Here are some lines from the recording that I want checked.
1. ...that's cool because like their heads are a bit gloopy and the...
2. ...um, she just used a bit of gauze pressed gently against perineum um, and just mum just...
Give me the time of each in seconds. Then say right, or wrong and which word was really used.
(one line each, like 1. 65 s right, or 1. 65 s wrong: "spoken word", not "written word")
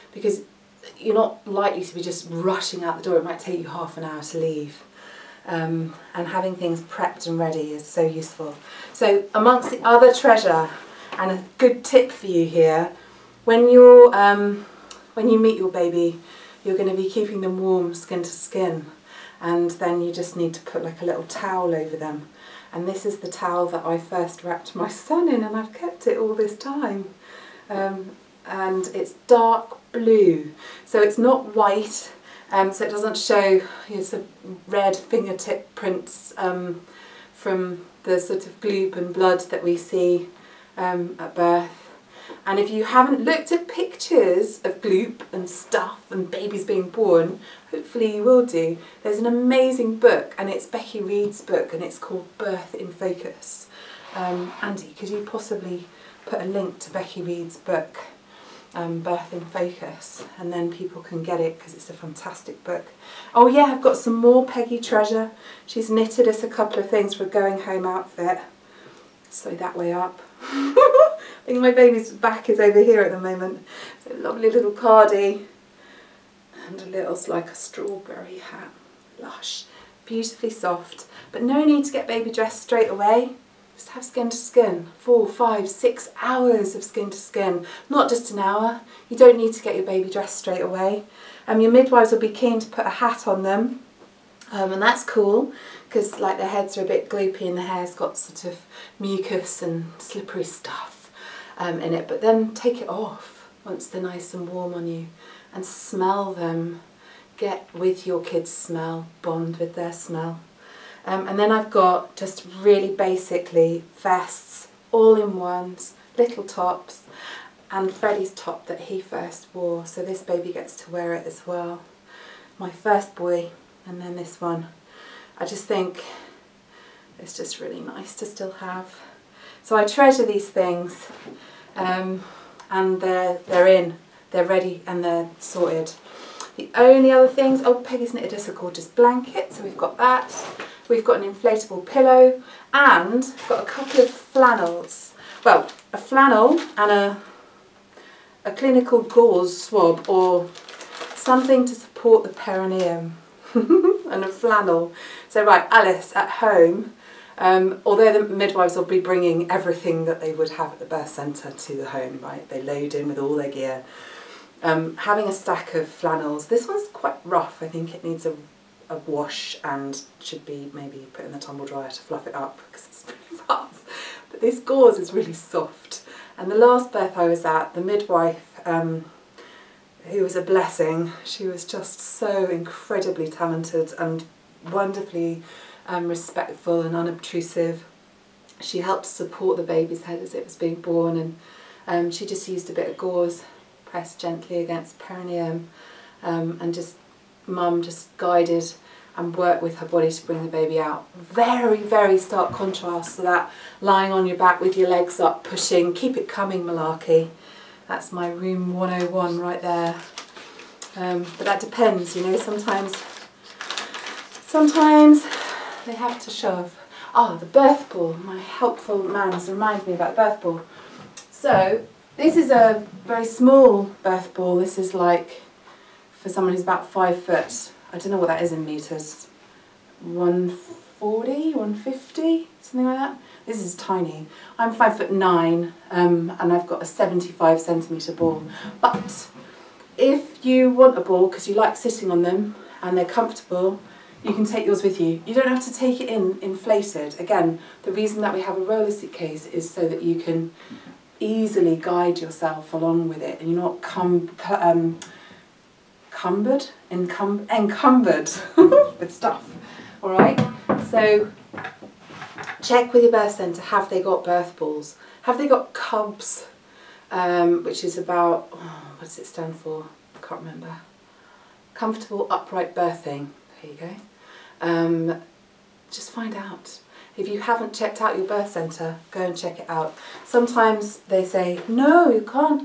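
1. 94 s right
2. 191 s right.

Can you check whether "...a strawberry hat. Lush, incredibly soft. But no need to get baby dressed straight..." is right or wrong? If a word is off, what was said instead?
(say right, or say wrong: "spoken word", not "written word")
wrong: "beautifully", not "incredibly".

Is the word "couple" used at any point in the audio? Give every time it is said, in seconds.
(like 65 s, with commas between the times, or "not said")
66 s, 143 s.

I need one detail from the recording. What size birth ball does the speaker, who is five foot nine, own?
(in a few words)
75 centimeters.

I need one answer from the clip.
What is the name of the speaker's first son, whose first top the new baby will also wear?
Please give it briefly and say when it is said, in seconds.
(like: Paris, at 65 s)
Freddie, at 117 s.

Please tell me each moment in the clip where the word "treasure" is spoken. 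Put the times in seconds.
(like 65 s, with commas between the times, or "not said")
10 s, 64 s, 129 s.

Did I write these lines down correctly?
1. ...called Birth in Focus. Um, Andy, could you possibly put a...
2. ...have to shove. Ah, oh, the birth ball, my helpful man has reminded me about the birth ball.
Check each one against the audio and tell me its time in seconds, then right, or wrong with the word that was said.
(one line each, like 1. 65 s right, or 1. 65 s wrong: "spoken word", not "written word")
1. 51 s right
2. 215 s right.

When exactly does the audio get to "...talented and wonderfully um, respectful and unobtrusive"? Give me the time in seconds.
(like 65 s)
183 s.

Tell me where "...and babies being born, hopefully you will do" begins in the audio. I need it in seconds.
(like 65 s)
46 s.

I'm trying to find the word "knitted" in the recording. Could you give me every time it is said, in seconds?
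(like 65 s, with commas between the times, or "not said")
65 s, 138 s.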